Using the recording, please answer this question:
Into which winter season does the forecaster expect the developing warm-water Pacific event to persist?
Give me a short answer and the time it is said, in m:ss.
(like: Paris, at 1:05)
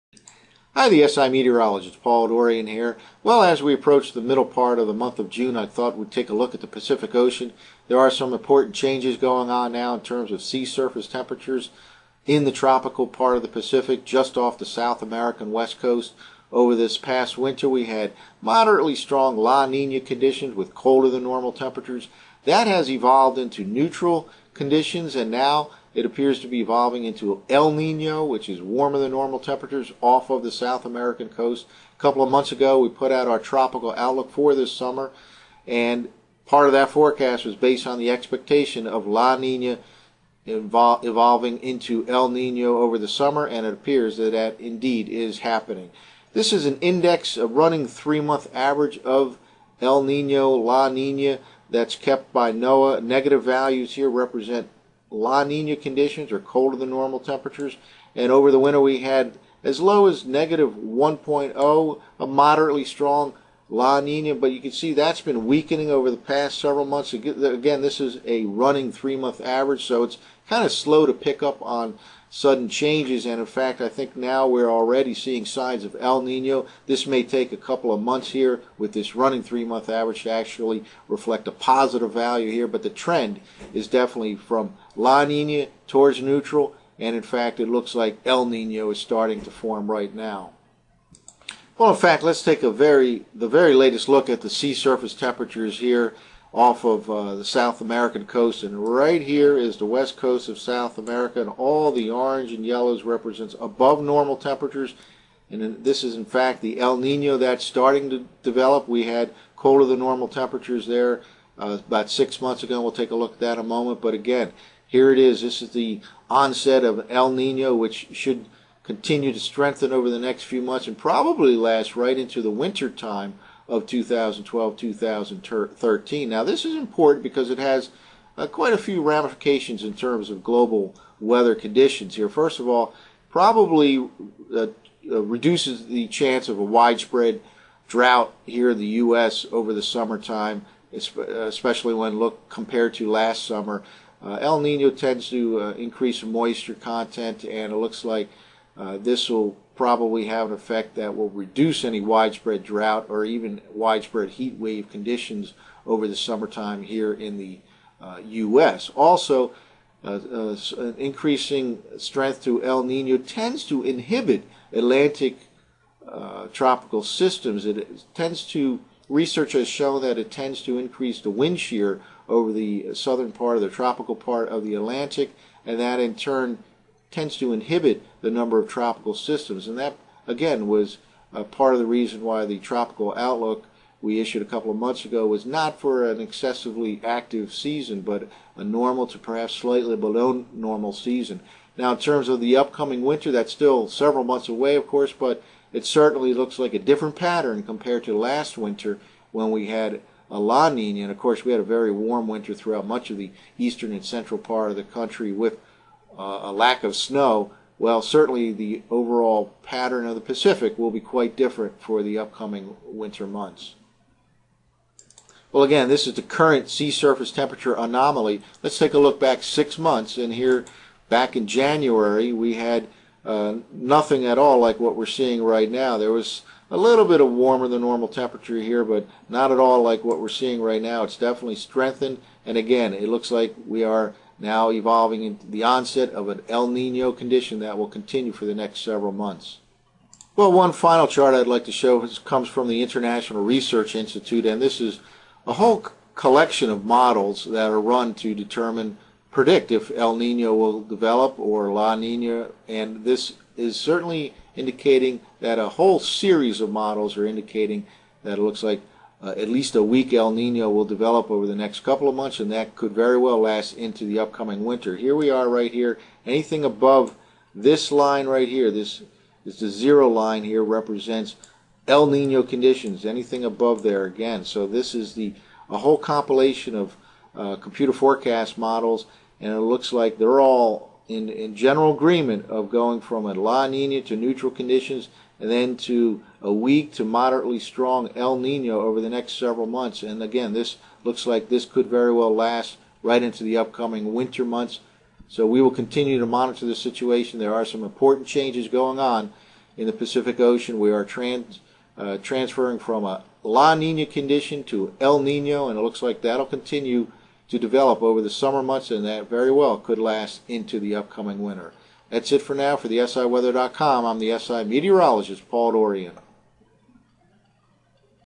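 2012-2013, at 2:03.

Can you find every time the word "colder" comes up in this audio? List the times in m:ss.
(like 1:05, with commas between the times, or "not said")
0:20, 0:56, 1:49.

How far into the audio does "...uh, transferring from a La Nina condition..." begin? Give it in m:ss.
5:01.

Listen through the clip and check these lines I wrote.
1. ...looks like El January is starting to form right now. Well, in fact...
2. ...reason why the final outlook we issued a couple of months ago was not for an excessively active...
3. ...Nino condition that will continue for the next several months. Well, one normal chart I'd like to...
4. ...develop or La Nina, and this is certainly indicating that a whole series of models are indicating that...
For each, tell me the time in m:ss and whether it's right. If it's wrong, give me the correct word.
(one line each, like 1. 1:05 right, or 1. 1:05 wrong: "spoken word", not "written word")
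1. 1:27 wrong: "Nino", not "January"
2. 3:01 wrong: "tropical", not "final"
3. 3:56 wrong: "final", not "normal"
4. 4:10 right.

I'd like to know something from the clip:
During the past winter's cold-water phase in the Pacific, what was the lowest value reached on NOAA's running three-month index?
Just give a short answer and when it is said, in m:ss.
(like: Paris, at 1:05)
-1.0, at 1:00.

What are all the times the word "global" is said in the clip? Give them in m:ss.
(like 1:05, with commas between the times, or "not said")
2:10.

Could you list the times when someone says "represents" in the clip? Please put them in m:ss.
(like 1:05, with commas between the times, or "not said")
0:54, 1:43, 4:30.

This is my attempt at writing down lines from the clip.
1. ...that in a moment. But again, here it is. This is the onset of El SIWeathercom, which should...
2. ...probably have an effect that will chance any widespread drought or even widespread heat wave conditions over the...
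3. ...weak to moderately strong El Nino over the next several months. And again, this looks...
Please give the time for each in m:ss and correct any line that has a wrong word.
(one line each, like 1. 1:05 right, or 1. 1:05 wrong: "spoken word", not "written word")
1. 1:53 wrong: "Nino", not "SIWeathercom"
2. 2:29 wrong: "reduce", not "chance"
3. 4:46 right.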